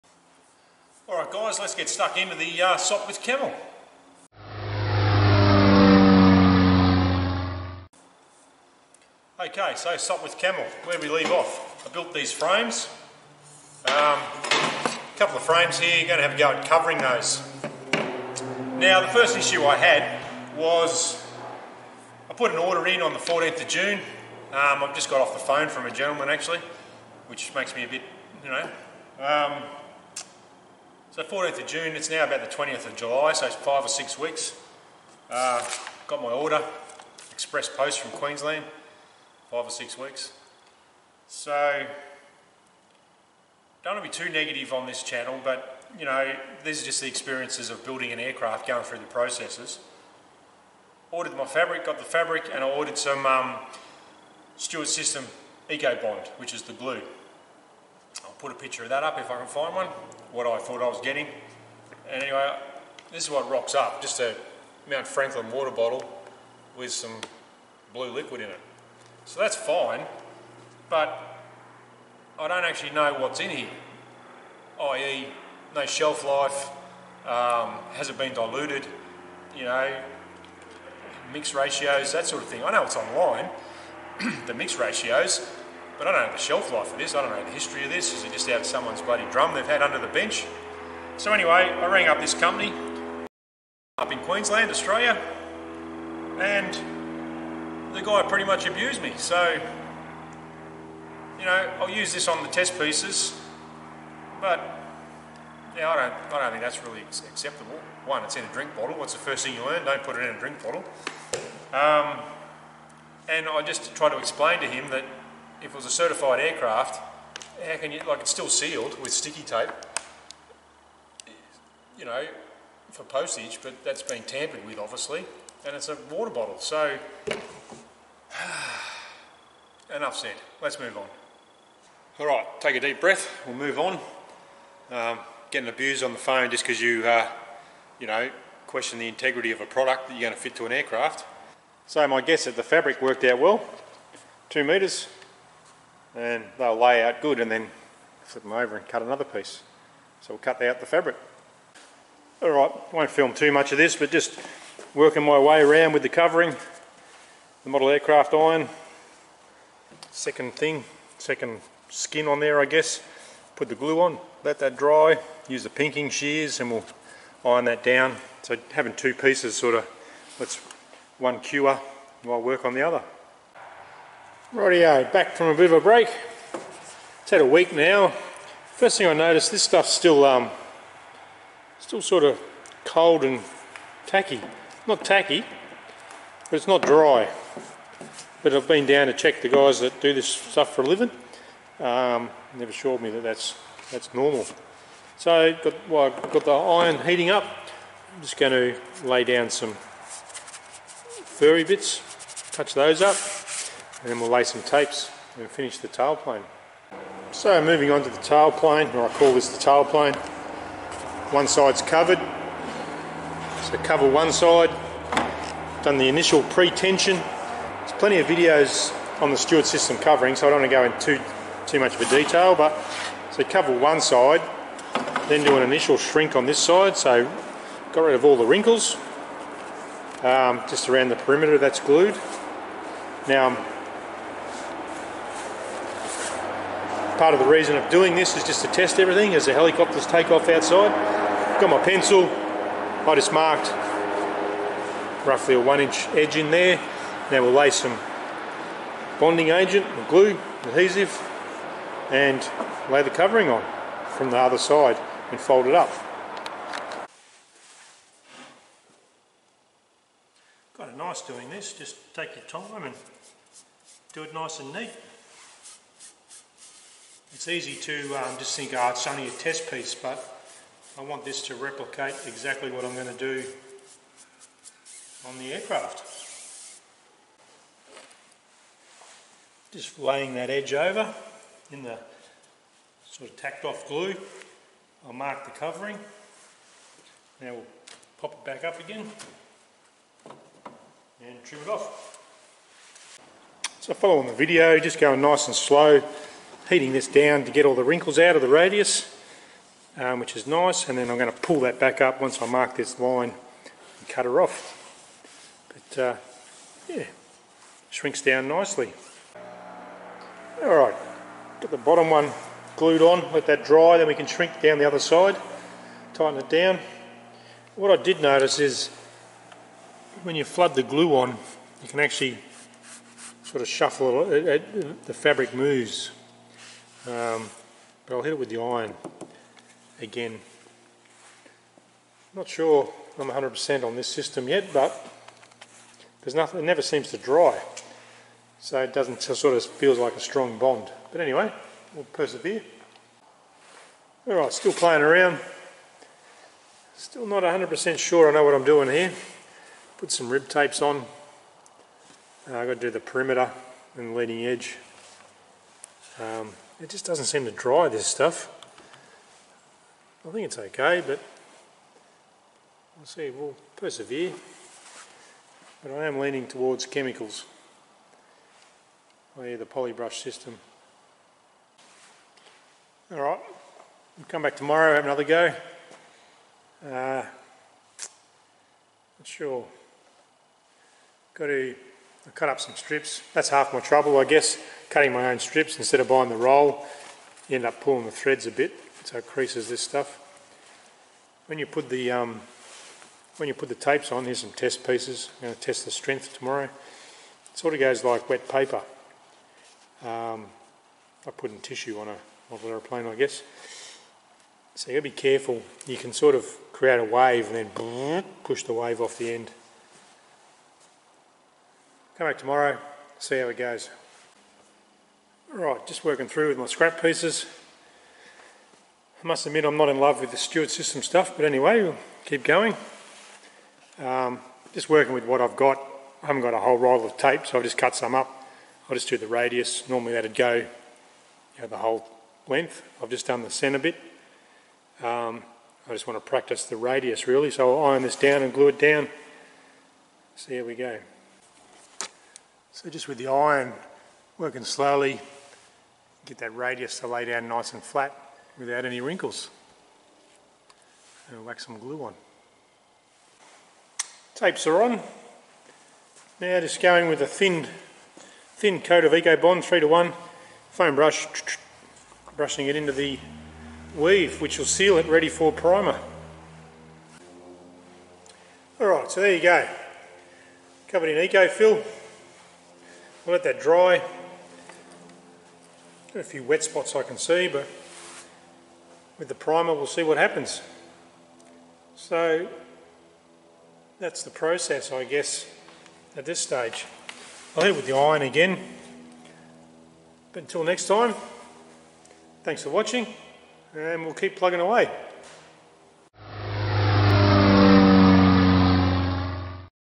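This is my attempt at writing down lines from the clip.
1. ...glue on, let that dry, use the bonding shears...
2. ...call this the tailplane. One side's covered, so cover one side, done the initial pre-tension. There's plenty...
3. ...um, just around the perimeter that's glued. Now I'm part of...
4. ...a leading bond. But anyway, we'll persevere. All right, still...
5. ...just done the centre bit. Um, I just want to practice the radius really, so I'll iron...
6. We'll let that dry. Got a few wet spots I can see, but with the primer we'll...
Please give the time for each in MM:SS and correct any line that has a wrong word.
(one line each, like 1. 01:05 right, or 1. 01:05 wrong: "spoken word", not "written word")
1. 02:43 wrong: "pinking", not "bonding"
2. 03:29 right
3. 03:50 right
4. 05:40 wrong: "strong", not "leading"
5. 07:13 right
6. 07:53 right.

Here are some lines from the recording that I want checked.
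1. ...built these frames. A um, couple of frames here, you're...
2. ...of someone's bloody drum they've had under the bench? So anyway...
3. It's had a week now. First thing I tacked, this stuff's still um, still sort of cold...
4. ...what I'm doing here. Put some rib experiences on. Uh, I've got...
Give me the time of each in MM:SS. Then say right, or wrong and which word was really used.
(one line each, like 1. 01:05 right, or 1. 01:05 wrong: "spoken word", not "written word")
1. 00:11 right
2. 01:28 right
3. 02:57 wrong: "noticed", not "tacked"
4. 05:48 wrong: "tapes", not "experiences".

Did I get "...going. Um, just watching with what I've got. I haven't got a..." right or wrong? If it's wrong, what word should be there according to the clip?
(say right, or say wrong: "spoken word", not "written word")
wrong: "working", not "watching".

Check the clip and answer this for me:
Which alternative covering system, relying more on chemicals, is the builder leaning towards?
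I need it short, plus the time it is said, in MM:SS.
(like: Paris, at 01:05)
Polybrush system, at 06:09.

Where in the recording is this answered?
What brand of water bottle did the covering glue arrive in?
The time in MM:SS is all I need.
01:04.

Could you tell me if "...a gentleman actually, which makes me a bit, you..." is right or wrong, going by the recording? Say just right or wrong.
right.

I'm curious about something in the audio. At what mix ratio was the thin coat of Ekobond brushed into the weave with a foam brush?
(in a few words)
3 to 1.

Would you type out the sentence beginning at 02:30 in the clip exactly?
So we'll cut out the fabric.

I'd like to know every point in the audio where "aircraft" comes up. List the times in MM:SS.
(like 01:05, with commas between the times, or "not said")
00:48, 01:56, 02:20, 02:37, 04:35.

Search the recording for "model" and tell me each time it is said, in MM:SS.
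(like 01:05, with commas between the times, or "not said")
02:37, 06:42.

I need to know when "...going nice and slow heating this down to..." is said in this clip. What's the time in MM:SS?
04:54.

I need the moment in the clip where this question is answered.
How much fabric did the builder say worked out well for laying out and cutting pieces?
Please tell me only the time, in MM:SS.
02:24.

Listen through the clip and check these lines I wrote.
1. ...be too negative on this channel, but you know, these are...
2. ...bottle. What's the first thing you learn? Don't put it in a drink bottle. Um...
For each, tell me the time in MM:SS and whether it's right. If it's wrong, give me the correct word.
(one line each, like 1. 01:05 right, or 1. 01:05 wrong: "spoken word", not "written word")
1. 00:44 right
2. 01:48 right.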